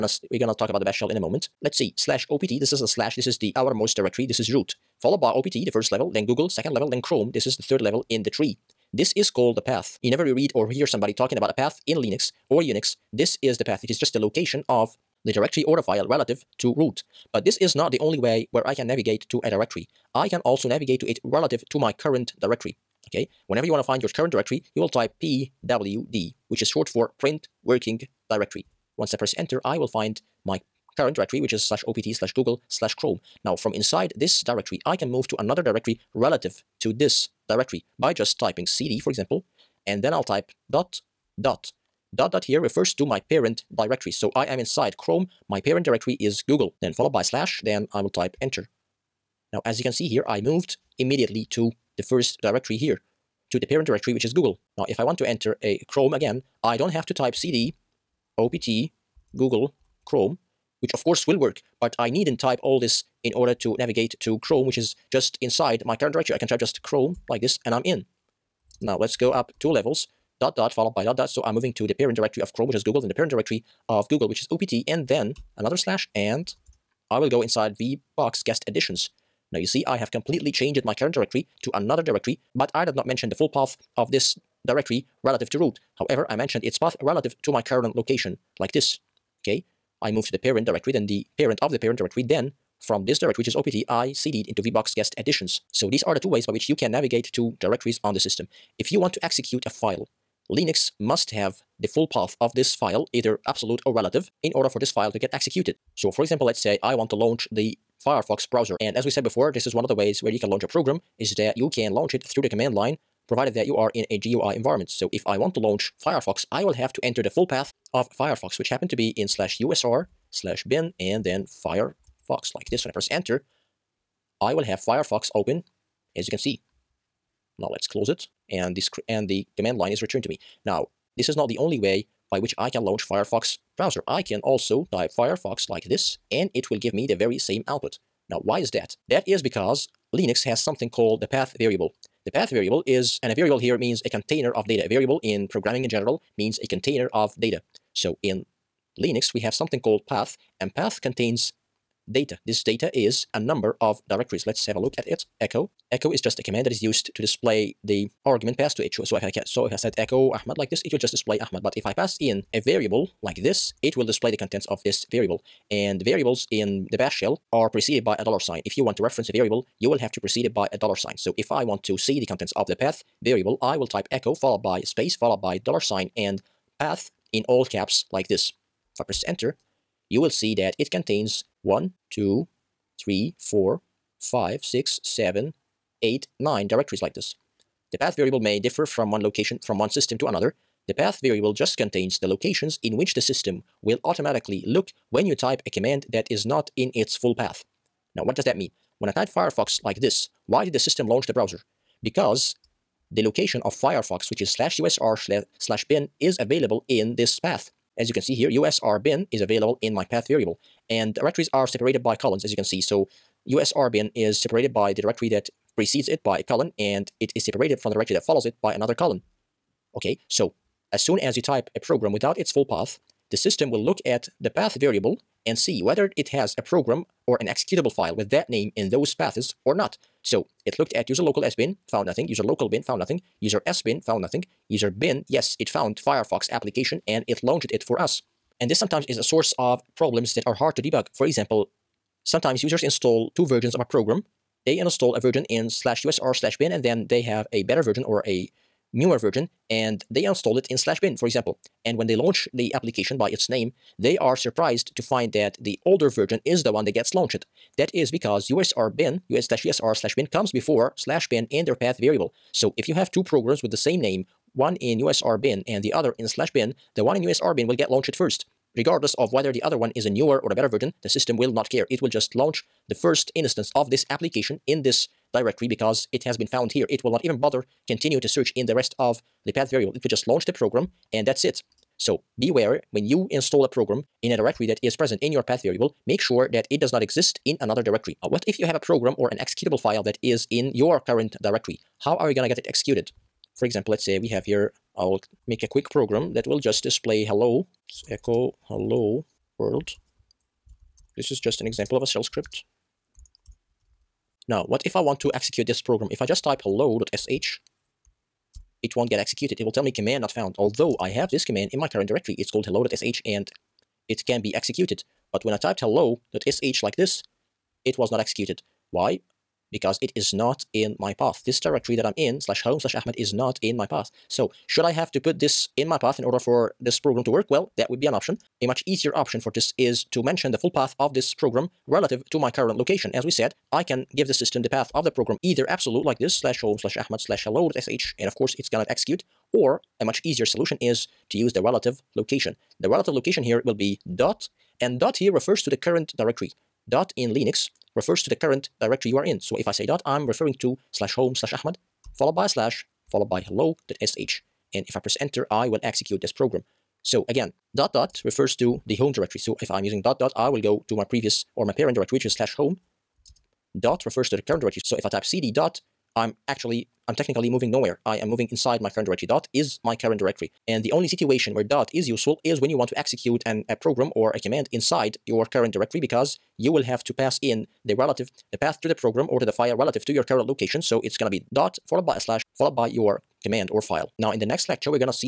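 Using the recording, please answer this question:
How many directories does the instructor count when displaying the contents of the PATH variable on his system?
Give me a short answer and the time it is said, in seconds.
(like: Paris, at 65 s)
9, at 186 s.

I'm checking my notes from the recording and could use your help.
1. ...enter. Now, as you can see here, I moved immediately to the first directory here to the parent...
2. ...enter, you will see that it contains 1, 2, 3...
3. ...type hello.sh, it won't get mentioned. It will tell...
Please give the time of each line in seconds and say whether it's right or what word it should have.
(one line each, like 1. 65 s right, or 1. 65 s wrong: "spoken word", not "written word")
1. 48 s right
2. 179 s right
3. 306 s wrong: "executed", not "mentioned".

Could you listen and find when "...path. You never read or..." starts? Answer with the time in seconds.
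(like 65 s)
9 s.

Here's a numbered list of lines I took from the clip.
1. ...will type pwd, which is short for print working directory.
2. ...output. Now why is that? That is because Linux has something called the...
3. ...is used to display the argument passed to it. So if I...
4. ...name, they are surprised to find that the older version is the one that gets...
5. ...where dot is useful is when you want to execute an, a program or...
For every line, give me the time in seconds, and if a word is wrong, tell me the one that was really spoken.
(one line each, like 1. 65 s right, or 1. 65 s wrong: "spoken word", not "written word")
1. 24 s right
2. 137 s right
3. 156 s right
4. 253 s right
5. 371 s right.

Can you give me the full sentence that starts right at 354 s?
And if I press enter, I will execute this program.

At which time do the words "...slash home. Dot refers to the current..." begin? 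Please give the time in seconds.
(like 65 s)
362 s.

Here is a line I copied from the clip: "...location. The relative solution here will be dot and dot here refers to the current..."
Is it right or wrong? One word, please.
wrong.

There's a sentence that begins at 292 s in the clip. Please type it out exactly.
How are you going to get it executed?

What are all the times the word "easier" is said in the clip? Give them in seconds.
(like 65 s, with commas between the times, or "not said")
328 s, 340 s.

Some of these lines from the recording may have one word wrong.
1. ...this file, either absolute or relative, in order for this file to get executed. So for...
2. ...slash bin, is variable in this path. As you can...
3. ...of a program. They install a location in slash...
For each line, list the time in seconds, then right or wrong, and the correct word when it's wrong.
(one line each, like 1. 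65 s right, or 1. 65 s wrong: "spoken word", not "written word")
1. 102 s right
2. 205 s wrong: "available", not "variable"
3. 243 s wrong: "version", not "location".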